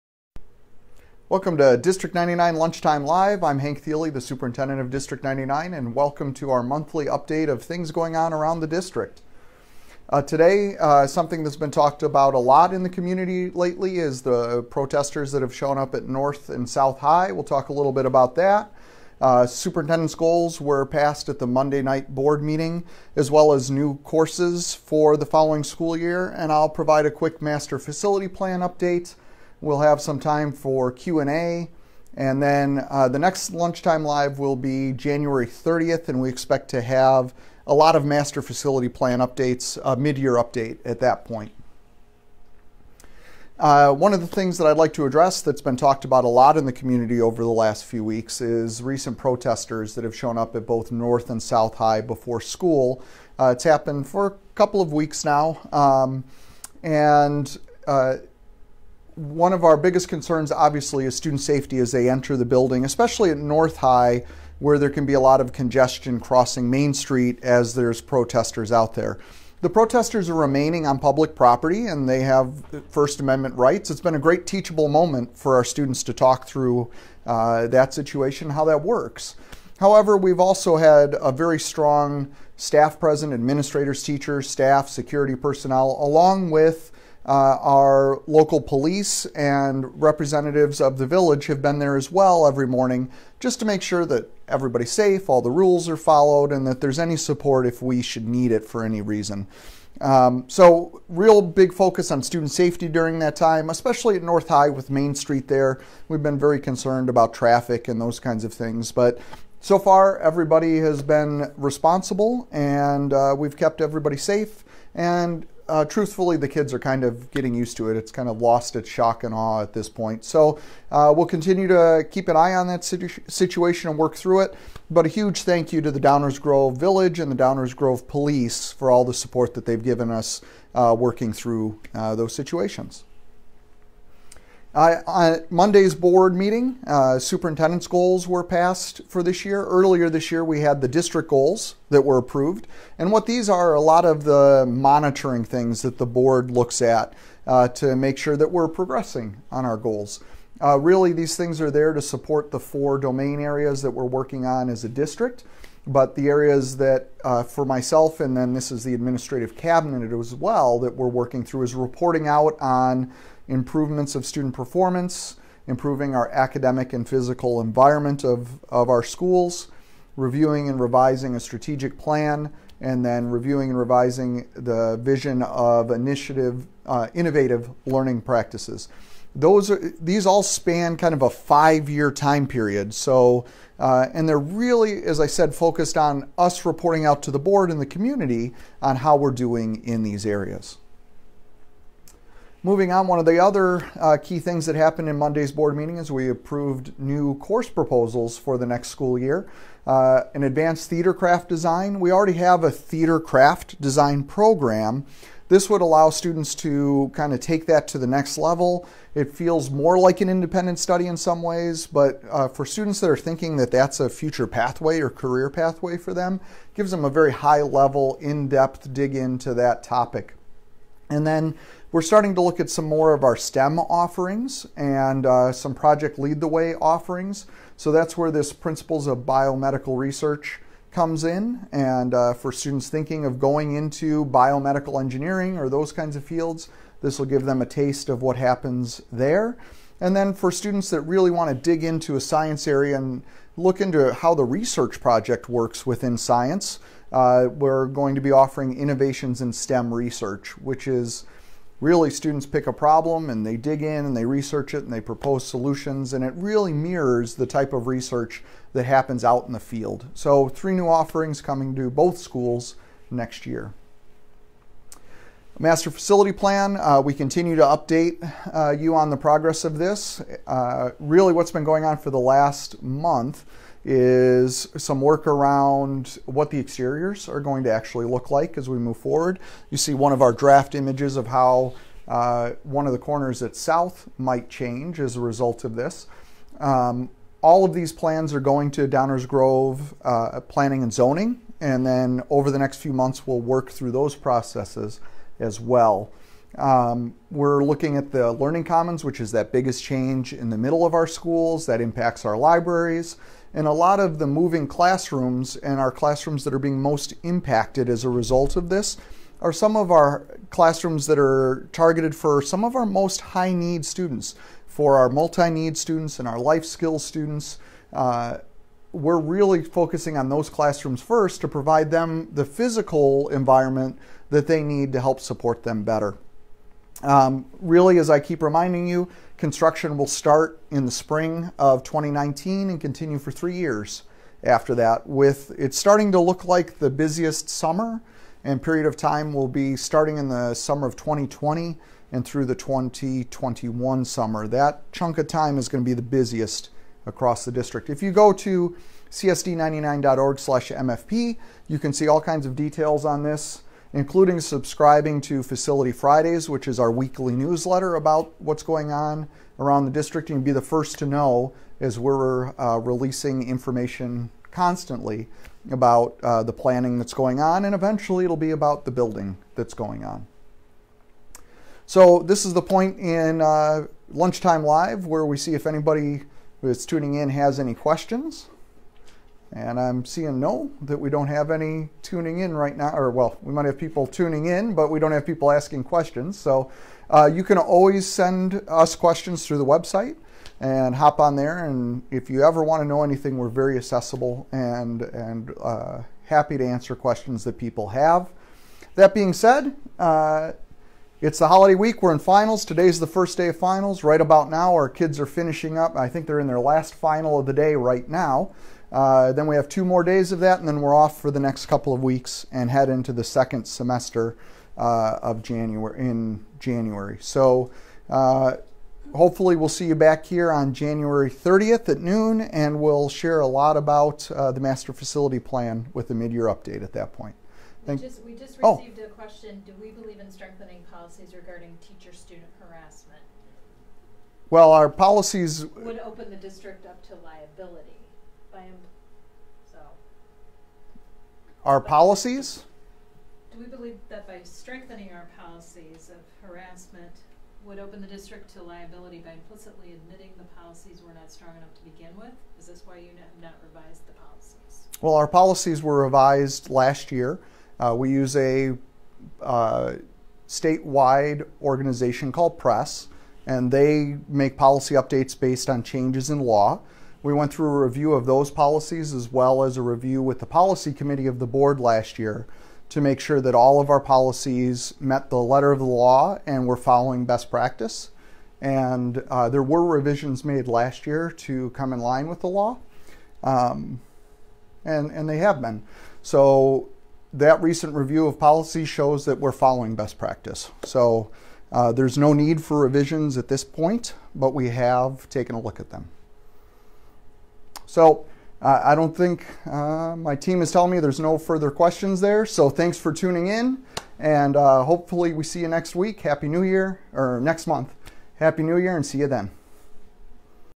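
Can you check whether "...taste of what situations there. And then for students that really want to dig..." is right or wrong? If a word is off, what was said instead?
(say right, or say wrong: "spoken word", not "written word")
wrong: "happens", not "situations".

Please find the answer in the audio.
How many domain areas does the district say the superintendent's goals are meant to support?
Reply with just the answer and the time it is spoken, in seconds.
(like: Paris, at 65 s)
4, at 152 s.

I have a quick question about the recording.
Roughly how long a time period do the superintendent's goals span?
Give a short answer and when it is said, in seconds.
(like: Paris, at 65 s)
5 years, at 181 s.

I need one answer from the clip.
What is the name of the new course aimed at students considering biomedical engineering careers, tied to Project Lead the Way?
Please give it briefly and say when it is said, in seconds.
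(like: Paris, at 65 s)
Principles of Biomedical Research, at 228 s.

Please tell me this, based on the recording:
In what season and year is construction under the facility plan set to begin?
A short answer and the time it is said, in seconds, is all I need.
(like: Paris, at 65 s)
Spring of 2019, at 330 s.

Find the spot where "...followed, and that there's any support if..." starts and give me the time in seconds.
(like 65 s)
95 s.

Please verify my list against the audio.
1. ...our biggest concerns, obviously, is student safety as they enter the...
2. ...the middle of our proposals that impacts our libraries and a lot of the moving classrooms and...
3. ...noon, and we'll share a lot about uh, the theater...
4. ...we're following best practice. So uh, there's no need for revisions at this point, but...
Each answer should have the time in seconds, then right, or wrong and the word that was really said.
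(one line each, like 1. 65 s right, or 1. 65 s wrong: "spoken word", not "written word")
1. 59 s right
2. 300 s wrong: "schools", not "proposals"
3. 421 s wrong: "master", not "theater"
4. 489 s right.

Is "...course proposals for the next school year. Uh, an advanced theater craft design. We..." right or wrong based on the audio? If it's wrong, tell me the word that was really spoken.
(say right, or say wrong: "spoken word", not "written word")
right.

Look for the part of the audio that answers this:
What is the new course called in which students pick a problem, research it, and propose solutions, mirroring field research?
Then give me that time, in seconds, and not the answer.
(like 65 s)
248 s.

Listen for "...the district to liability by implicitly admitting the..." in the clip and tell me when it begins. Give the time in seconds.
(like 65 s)
448 s.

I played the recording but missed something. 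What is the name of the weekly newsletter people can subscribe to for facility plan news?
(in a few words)
Facility Fridays.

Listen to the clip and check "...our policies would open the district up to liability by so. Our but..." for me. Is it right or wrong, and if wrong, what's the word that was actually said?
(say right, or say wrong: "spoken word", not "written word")
right.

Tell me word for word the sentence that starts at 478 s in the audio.
And uh, there were revisions made last year to come in line with the law, um, and, and they have been.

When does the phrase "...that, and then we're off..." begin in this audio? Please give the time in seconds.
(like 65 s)
410 s.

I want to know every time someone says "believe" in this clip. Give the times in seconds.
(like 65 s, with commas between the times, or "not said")
429 s, 443 s.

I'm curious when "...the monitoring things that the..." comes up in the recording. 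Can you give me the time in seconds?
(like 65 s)
144 s.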